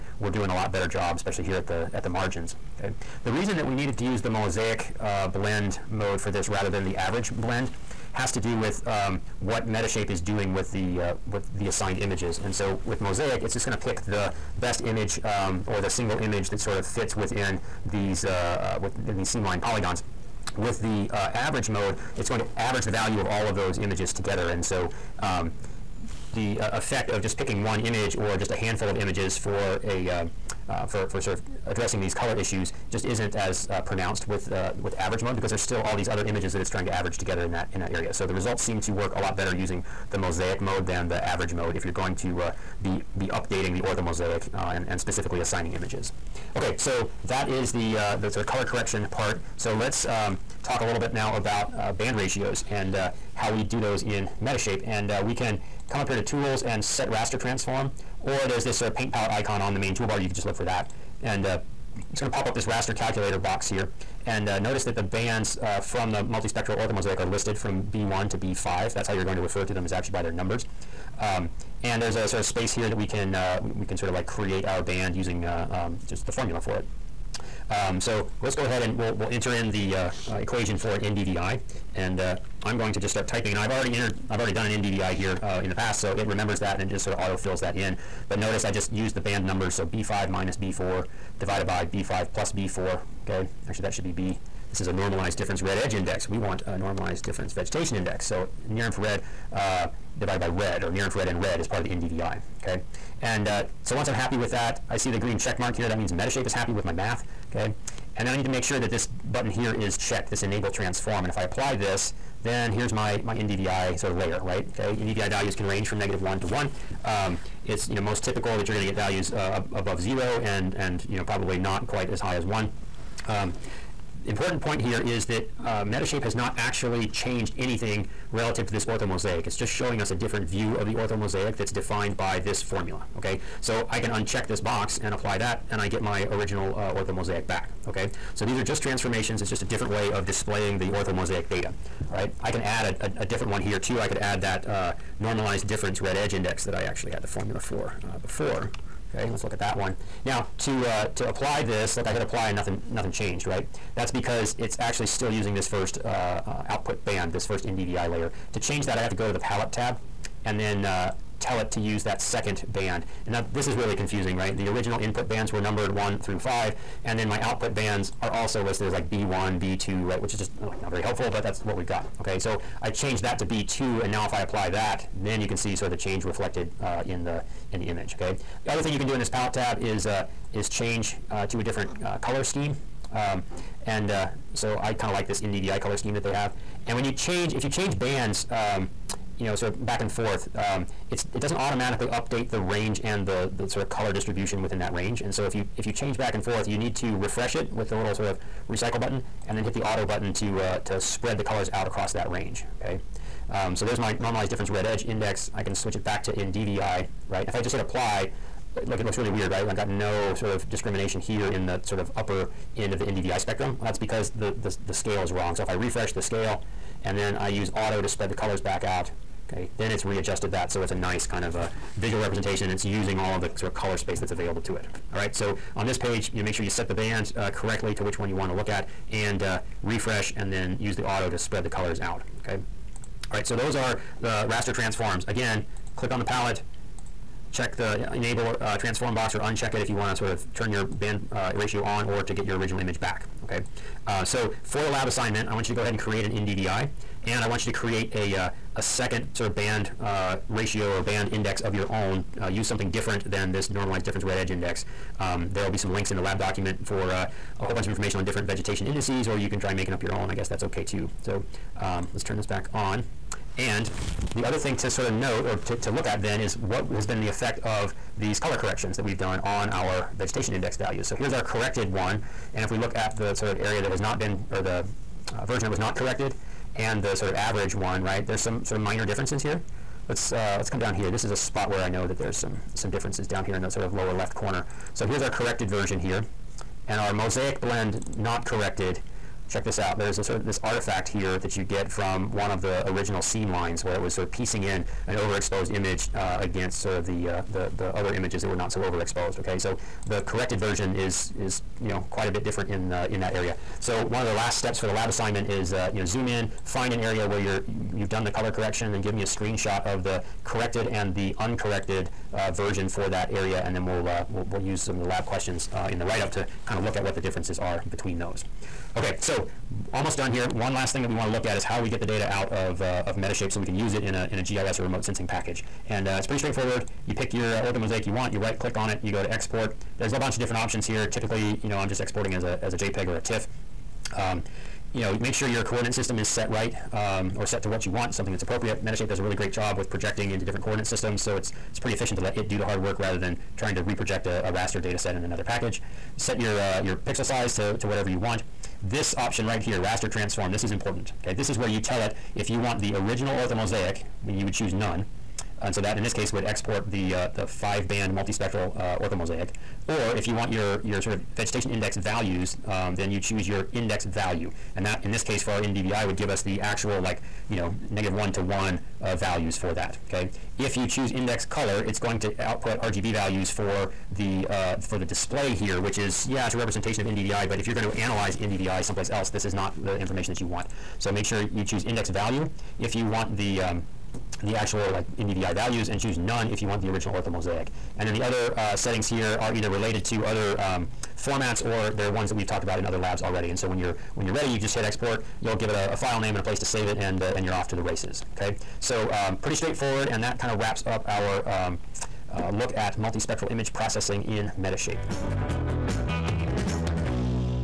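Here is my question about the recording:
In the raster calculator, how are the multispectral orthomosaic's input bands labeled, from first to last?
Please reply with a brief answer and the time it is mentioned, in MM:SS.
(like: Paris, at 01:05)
B1 to B5, at 01:07.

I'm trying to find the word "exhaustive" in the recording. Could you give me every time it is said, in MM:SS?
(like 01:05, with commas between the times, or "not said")
not said.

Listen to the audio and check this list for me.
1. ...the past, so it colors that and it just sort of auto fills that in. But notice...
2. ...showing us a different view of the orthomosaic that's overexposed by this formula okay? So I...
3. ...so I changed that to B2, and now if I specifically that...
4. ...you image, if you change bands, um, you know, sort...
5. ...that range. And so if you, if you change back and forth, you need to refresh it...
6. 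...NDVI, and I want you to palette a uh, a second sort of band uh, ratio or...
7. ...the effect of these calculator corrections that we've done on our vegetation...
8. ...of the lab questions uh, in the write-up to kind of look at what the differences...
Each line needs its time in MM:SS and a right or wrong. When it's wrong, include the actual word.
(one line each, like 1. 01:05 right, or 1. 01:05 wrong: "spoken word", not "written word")
1. 01:25 wrong: "remembers", not "colors"
2. 02:09 wrong: "defined", not "overexposed"
3. 02:52 wrong: "apply", not "specifically"
4. 03:07 wrong: "change", not "image"
5. 03:14 right
6. 04:06 wrong: "create", not "palette"
7. 04:27 wrong: "color", not "calculator"
8. 05:14 right.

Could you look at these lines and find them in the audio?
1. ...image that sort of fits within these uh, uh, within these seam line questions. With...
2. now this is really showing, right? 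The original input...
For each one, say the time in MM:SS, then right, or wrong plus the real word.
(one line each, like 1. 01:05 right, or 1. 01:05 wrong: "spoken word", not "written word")
1. 00:16 wrong: "polygons", not "questions"
2. 02:43 wrong: "confusing", not "showing".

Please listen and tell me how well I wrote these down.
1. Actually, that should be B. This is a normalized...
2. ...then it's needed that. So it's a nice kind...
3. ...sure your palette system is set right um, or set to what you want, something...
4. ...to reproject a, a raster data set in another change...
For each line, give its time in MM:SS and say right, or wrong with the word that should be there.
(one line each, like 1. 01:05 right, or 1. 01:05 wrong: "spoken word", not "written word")
1. 01:33 right
2. 03:39 wrong: "readjusted", not "needed"
3. 05:35 wrong: "coordinate", not "palette"
4. 05:43 wrong: "package", not "change".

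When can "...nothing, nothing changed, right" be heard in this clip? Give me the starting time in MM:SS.
02:32.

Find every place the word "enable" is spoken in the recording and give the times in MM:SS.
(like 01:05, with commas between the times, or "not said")
01:50, 03:58.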